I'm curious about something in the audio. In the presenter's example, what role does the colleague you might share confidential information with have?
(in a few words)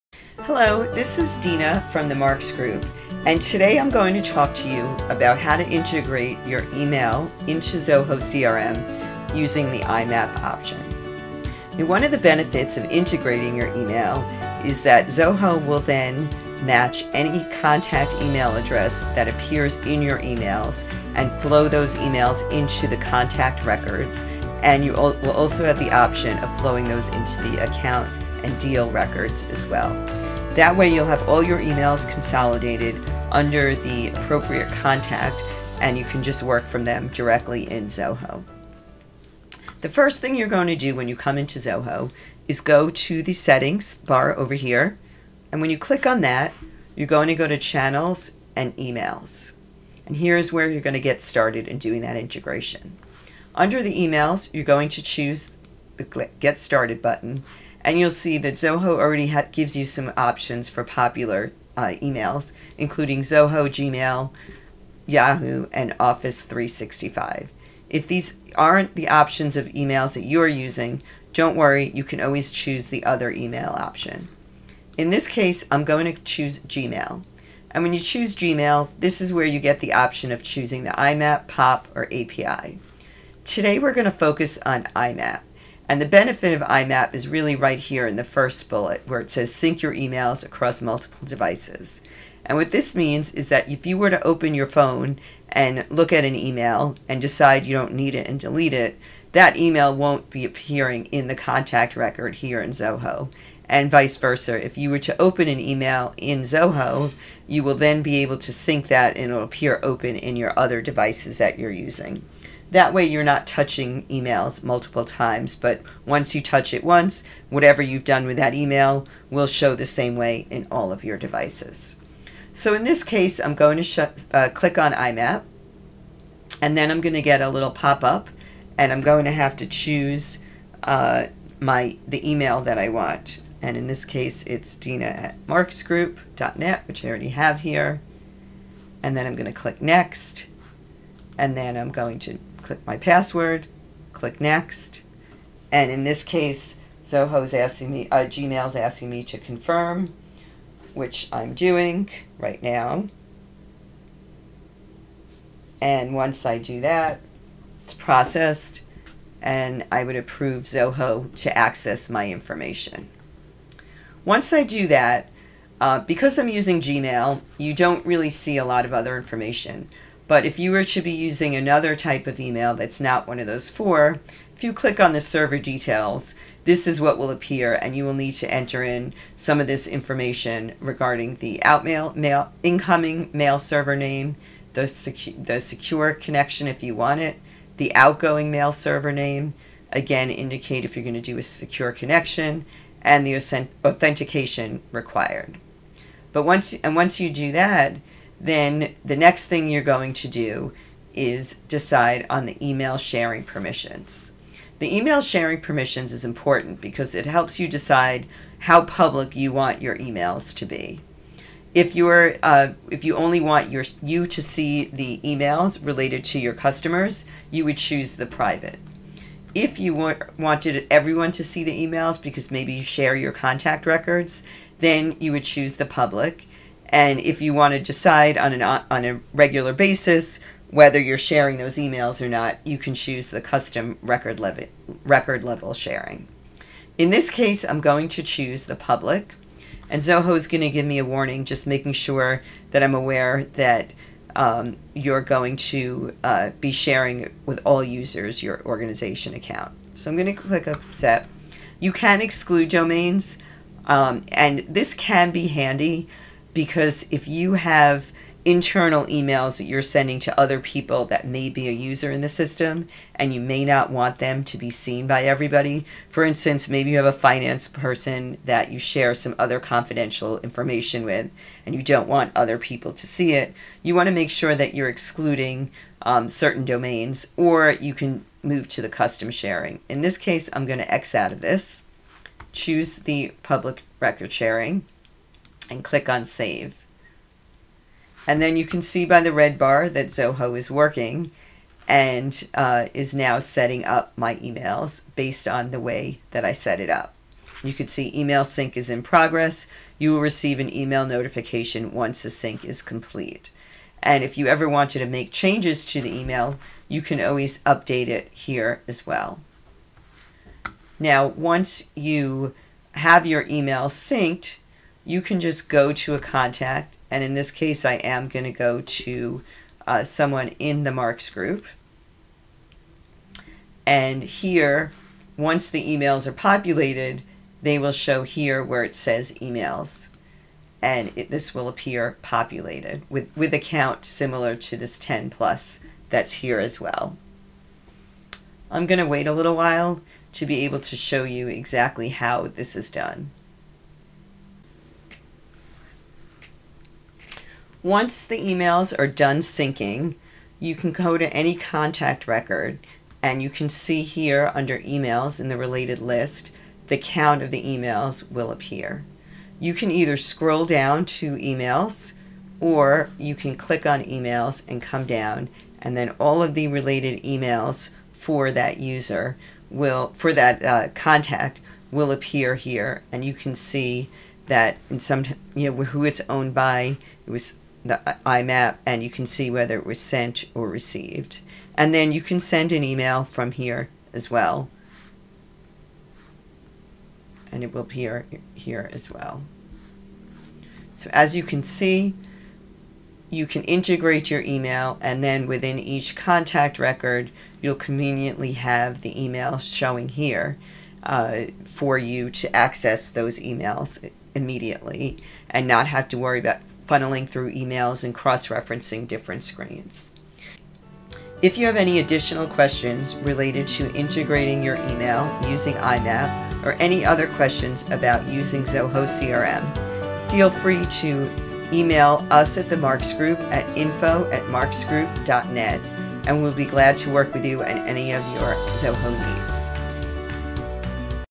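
Finance person.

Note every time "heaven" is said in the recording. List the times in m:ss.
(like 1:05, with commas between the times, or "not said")
not said.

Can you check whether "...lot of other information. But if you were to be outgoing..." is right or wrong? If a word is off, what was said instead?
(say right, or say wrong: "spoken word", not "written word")
wrong: "using", not "outgoing".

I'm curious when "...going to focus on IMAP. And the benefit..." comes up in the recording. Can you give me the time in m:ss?
1:23.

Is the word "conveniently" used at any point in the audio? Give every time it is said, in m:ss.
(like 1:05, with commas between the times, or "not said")
6:37.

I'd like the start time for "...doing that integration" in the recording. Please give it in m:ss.
0:51.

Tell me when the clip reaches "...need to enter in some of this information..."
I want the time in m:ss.
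2:58.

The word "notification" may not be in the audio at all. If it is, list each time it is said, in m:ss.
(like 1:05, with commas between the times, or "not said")
5:01.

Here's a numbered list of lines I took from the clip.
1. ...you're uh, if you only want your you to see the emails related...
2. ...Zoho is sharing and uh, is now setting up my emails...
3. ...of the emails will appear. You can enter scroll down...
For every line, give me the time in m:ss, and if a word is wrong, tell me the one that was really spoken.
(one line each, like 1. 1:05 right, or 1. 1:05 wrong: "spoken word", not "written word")
1. 3:31 right
2. 4:50 wrong: "working", not "sharing"
3. 5:57 wrong: "either", not "enter".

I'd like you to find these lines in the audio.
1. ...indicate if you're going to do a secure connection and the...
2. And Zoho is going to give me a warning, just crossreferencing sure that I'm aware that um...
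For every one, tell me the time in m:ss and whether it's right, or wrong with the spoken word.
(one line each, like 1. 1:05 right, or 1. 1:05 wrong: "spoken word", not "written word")
1. 3:10 right
2. 3:59 wrong: "making", not "crossreferencing".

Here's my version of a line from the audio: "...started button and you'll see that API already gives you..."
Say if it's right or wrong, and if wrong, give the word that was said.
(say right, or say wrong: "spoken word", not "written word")
wrong: "Zoho", not "API".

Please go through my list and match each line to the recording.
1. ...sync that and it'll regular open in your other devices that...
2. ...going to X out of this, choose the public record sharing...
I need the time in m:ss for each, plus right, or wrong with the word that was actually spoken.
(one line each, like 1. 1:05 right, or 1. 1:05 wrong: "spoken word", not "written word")
1. 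1:48 wrong: "appear", not "regular"
2. 4:40 right.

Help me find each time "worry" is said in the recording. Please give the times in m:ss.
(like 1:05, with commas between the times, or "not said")
1:11, 6:46.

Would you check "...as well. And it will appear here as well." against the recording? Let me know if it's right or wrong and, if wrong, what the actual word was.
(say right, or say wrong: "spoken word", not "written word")
right.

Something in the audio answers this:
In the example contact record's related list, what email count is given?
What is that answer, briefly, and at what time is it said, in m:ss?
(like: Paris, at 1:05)
10+, at 5:34.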